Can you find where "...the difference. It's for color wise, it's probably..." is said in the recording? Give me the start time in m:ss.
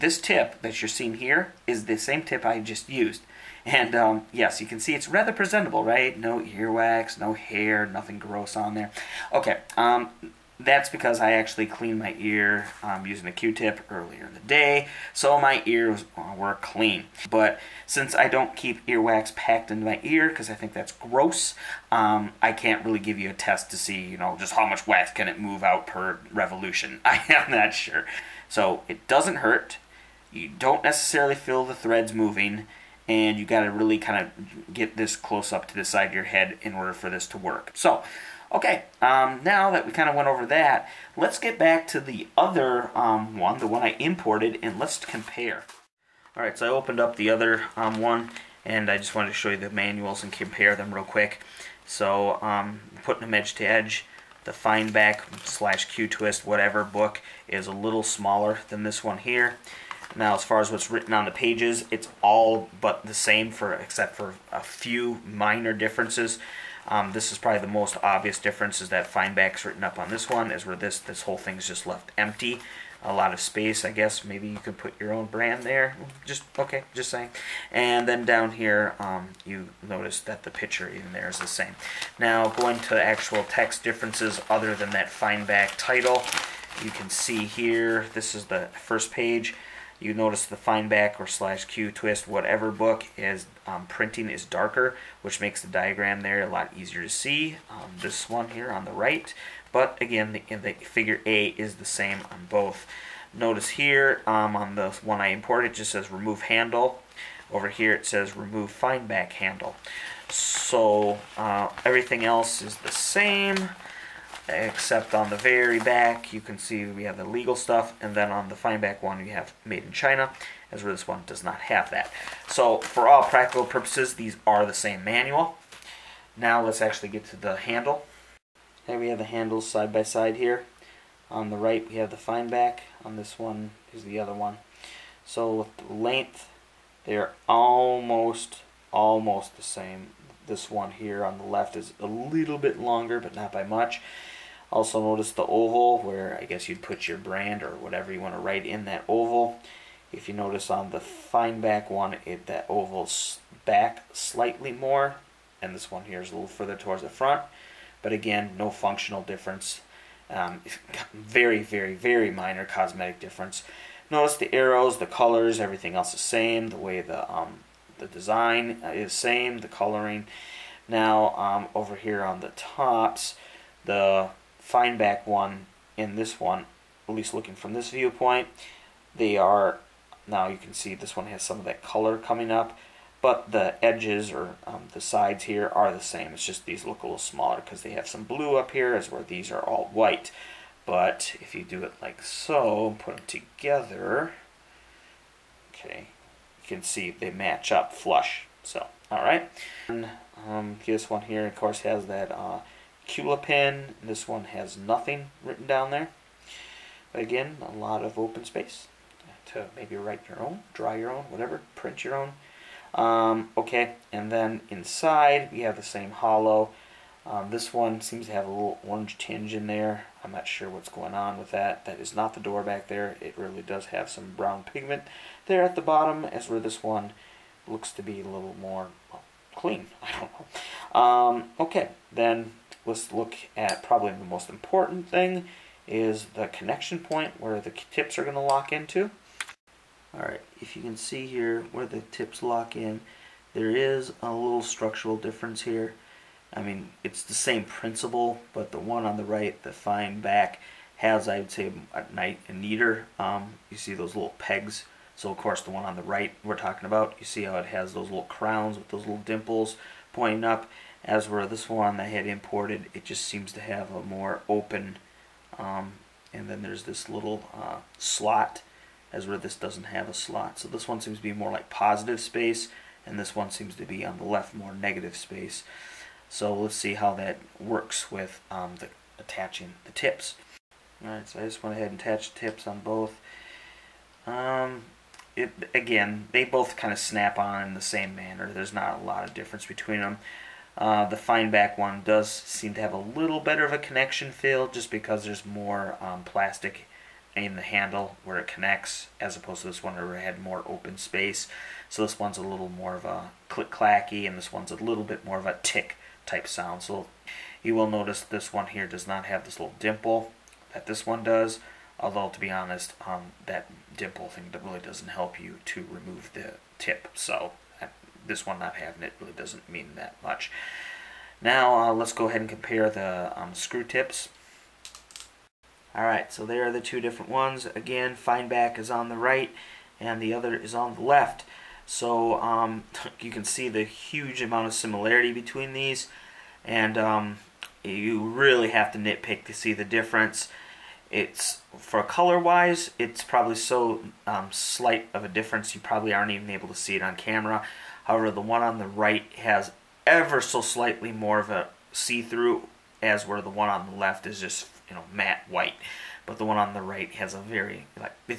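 5:39.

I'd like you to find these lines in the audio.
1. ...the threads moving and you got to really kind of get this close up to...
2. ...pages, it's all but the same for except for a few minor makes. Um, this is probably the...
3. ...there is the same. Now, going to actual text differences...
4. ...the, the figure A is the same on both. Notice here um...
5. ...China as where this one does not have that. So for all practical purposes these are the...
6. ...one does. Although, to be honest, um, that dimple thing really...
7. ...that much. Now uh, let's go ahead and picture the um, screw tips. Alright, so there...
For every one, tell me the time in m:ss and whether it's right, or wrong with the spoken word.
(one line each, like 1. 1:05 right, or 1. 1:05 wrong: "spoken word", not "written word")
1. 0:31 right
2. 1:01 wrong: "differences", not "makes"
3. 1:21 right
4. 1:40 right
5. 1:59 right
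6. 5:11 right
7. 5:19 wrong: "compare", not "picture".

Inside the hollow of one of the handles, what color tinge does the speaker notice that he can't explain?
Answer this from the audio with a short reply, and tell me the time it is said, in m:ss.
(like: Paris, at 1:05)
orange, at 3:38.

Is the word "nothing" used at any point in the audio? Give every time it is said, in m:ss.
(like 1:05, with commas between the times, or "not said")
0:07, 3:24.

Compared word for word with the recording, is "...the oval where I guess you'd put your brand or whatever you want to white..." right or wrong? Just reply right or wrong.
wrong.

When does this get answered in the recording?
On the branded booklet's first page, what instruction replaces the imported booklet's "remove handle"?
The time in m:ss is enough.
1:48.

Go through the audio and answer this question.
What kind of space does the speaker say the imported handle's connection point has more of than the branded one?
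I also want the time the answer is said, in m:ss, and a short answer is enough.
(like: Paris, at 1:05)
negative space, at 4:34.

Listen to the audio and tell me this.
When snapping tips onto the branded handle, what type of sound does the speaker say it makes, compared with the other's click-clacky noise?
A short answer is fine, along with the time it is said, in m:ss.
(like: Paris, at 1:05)
tick, at 5:05.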